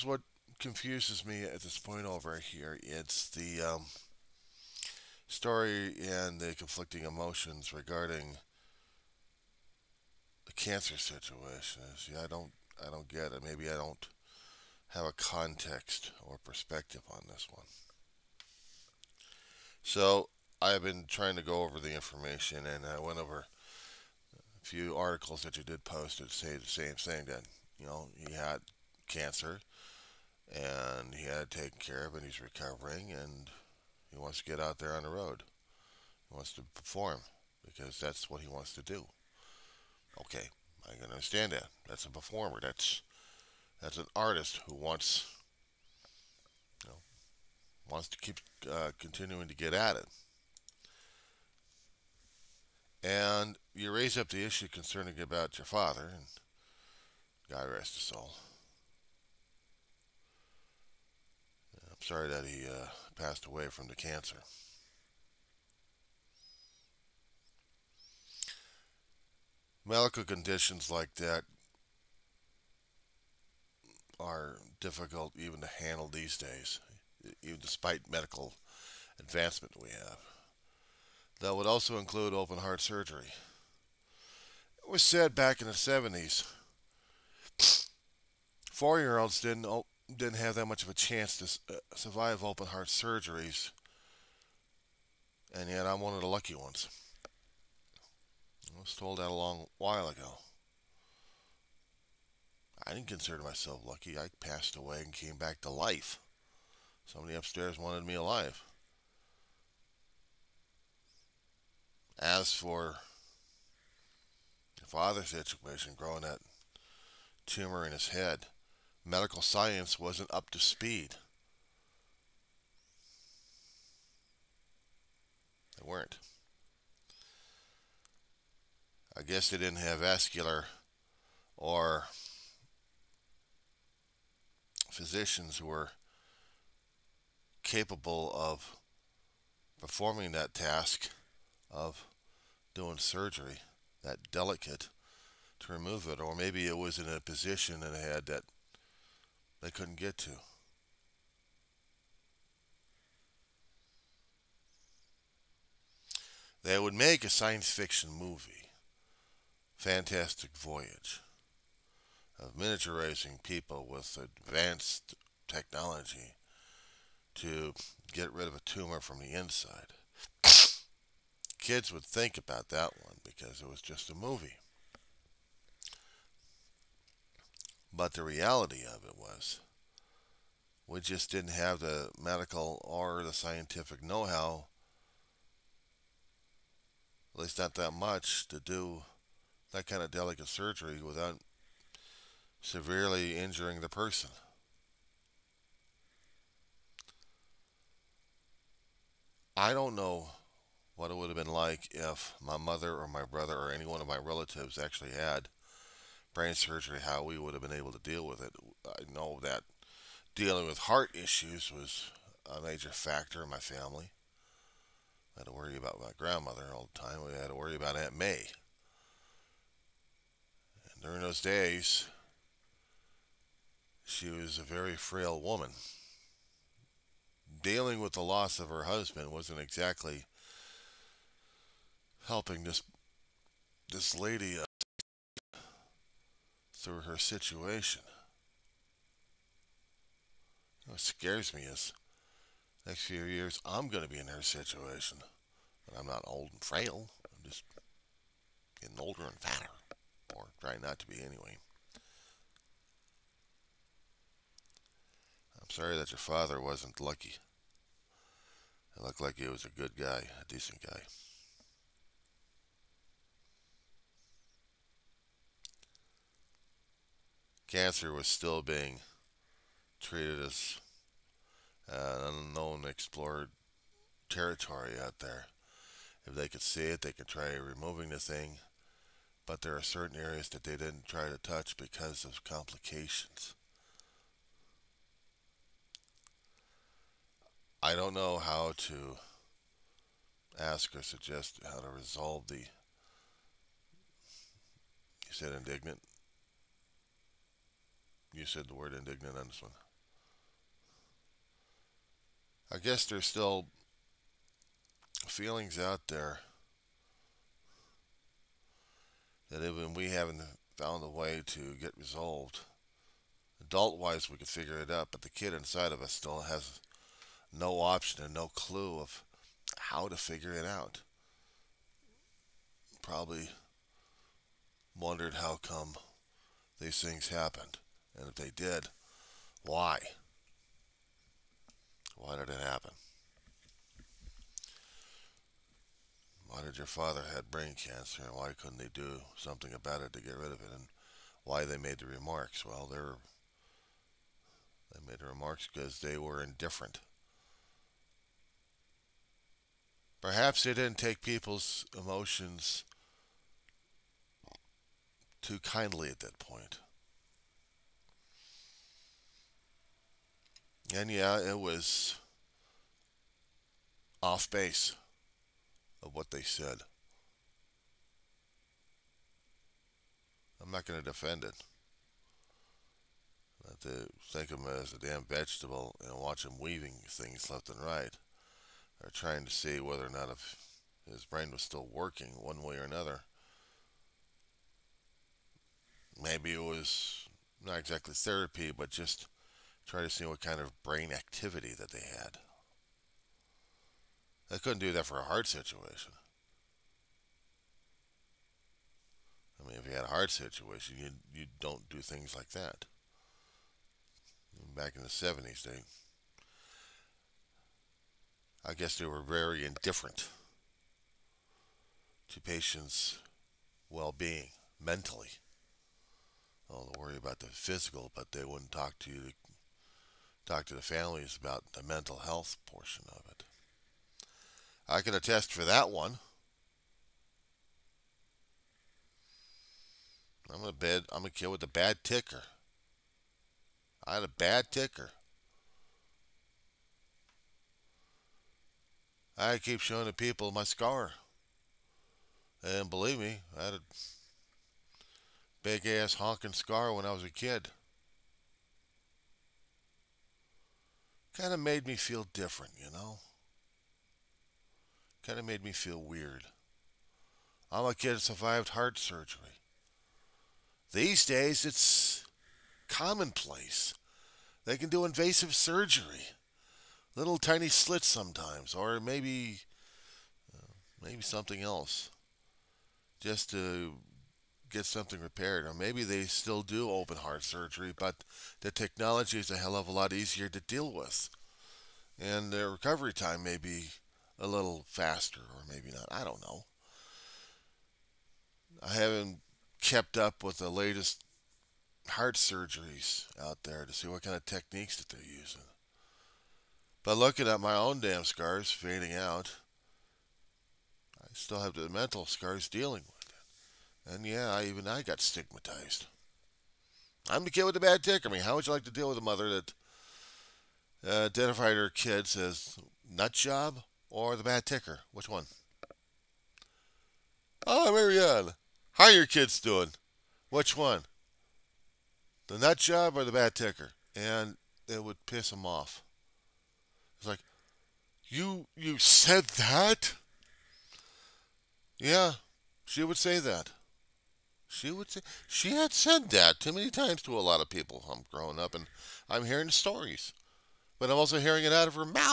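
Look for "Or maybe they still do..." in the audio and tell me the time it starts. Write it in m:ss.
7:55.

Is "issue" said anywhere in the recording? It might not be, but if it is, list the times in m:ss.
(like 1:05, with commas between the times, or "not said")
0:54, 3:31.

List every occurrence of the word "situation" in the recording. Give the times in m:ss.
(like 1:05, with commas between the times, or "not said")
0:10, 1:55, 3:57, 4:04, 6:35, 6:40.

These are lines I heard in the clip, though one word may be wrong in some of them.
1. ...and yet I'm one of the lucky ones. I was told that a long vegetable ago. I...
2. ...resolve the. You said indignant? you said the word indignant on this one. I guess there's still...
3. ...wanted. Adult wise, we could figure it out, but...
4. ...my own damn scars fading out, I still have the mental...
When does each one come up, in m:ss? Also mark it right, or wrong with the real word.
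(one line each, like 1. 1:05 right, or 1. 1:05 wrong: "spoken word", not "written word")
1. 1:35 wrong: "while", not "vegetable"
2. 4:51 right
3. 5:11 wrong: "resolved", not "wanted"
4. 8:17 right.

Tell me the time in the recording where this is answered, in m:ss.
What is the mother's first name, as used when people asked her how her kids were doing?
8:37.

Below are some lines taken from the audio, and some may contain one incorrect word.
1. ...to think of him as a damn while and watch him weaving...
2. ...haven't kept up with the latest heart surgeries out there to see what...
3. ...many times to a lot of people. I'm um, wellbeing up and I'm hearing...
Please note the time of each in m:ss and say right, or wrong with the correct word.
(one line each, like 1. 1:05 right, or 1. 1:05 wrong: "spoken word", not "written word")
1. 6:13 wrong: "vegetable", not "while"
2. 8:08 right
3. 8:56 wrong: "growing", not "wellbeing".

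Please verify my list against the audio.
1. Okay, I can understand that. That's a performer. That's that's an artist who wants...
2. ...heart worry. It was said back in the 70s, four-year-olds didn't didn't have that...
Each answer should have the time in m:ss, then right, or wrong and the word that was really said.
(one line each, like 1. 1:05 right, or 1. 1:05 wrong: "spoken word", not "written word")
1. 0:40 right
2. 1:22 wrong: "surgery", not "worry".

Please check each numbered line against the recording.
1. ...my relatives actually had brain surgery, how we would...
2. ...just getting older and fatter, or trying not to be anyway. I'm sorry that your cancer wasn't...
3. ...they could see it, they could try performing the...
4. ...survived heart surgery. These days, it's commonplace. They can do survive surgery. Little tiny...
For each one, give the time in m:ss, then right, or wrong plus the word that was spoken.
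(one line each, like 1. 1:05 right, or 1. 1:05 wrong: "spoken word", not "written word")
1. 3:24 right
2. 4:07 wrong: "father", not "cancer"
3. 4:36 wrong: "removing", not "performing"
4. 7:38 wrong: "invasive", not "survive".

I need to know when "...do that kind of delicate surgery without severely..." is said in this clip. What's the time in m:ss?
3:08.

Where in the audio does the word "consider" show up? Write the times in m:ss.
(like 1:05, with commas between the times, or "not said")
1:43.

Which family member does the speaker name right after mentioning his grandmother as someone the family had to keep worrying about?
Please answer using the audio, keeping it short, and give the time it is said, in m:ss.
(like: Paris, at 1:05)
Aunt May, at 3:37.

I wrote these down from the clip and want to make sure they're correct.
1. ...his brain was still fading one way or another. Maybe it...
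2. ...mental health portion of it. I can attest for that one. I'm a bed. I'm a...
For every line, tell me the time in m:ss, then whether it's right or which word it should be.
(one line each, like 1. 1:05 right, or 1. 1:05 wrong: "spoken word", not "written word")
1. 6:21 wrong: "working", not "fading"
2. 7:01 right.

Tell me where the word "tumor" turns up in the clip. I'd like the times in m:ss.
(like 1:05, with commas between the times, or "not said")
1:57, 2:48.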